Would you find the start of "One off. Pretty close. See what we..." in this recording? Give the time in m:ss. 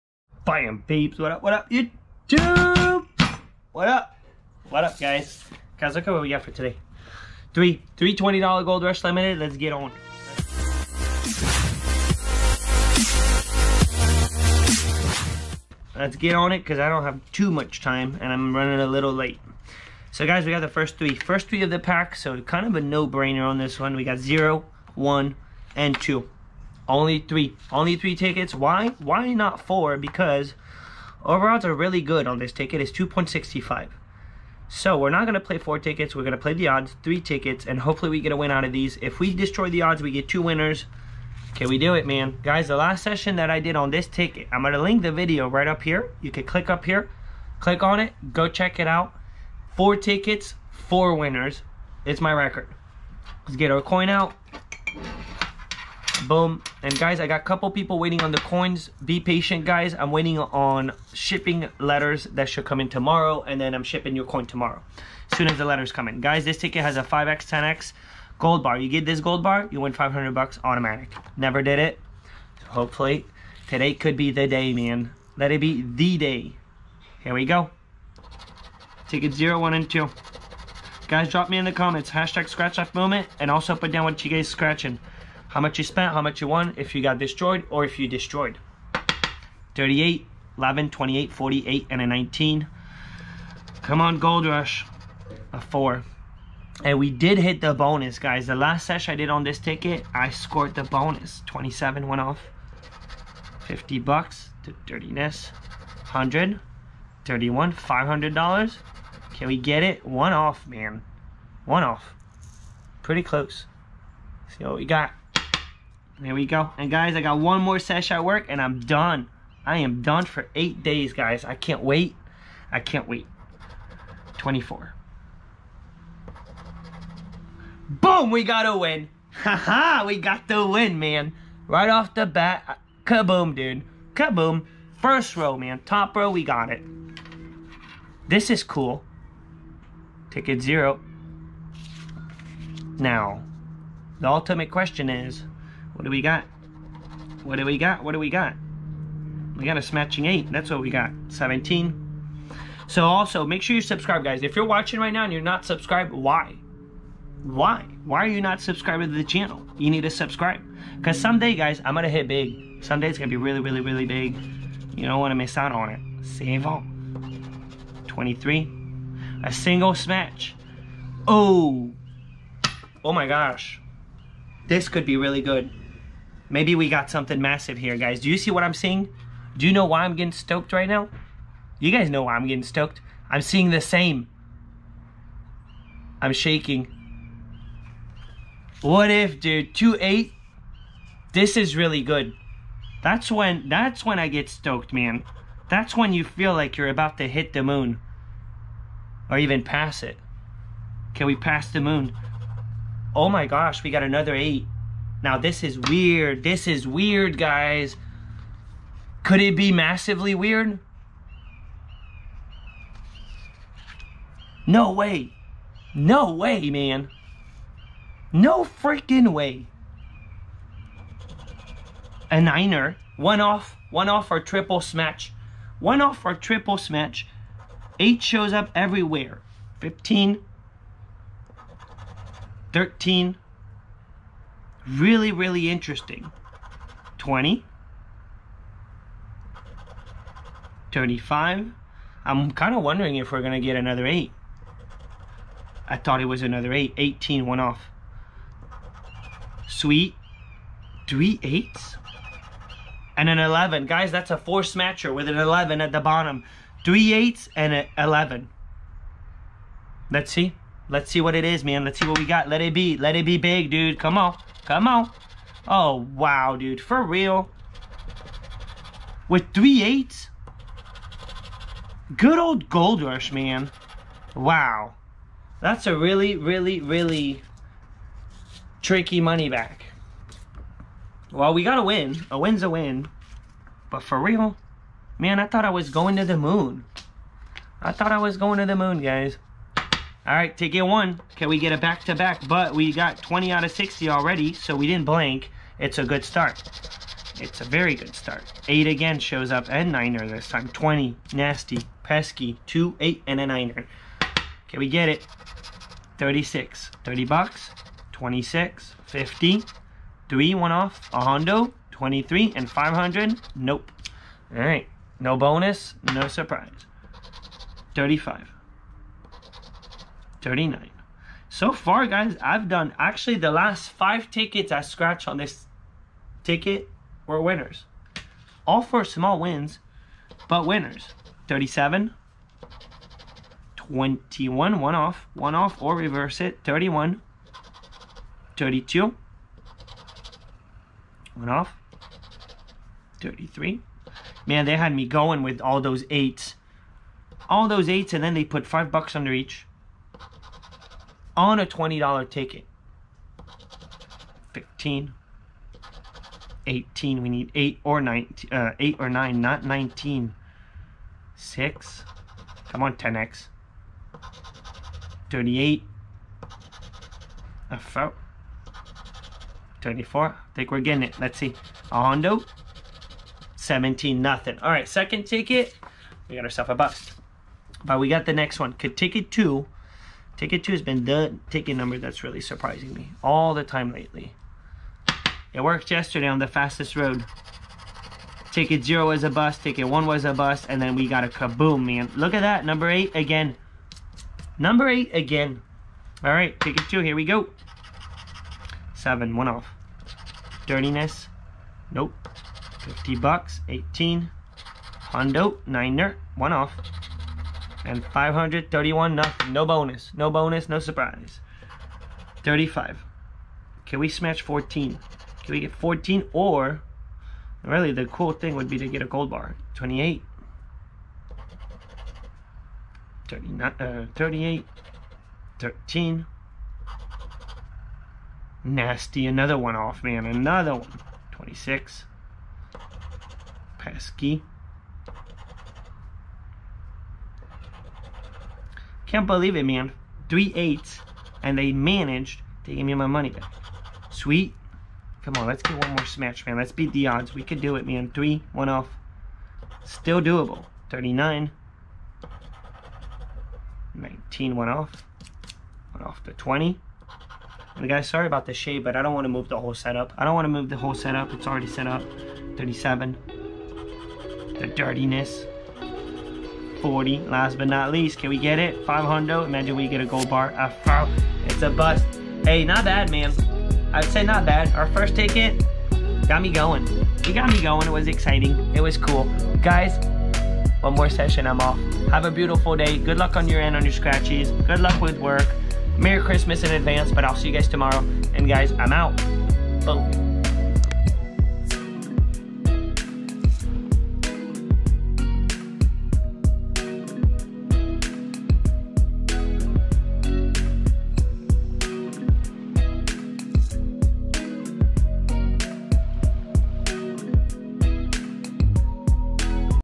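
1:51.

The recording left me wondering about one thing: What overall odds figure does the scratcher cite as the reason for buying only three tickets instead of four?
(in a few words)
2.65.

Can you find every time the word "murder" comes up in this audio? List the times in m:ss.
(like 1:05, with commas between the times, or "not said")
not said.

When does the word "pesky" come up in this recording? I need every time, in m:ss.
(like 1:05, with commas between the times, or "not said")
5:02, 7:13.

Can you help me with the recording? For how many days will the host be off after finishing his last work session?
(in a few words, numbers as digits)
8.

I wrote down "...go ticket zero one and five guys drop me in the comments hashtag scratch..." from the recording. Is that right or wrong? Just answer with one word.
wrong.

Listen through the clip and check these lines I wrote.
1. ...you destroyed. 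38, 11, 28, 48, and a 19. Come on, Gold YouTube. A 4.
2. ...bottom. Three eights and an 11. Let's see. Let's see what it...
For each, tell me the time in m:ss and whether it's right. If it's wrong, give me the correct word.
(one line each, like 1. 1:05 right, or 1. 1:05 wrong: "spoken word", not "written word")
1. 1:27 wrong: "Rush", not "YouTube"
2. 4:15 right.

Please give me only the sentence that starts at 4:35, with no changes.
That's a really, really, really tricky money back.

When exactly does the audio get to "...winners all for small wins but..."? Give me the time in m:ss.
5:27.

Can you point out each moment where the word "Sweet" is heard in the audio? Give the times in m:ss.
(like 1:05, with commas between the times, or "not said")
4:09, 7:24.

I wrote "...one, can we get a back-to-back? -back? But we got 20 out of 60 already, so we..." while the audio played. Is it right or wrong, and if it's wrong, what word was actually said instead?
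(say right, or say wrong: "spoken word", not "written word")
right.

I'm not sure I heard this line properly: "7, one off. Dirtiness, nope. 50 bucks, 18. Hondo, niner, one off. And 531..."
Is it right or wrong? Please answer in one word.
right.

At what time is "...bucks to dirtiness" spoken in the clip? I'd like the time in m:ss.
1:43.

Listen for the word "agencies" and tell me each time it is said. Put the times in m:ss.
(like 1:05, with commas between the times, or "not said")
not said.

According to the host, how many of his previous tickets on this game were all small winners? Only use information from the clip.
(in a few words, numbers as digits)
5.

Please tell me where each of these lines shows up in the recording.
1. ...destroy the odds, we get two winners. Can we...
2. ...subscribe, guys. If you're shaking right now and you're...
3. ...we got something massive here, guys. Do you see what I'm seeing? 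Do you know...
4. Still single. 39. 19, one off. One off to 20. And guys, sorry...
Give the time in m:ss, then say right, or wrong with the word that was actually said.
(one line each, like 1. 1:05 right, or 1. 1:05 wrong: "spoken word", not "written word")
1. 0:39 right
2. 2:33 wrong: "watching", not "shaking"
3. 2:56 right
4. 7:29 wrong: "doable", not "single".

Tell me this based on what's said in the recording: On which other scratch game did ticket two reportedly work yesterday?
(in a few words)
Fastest Road.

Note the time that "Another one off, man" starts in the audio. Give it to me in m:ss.
7:09.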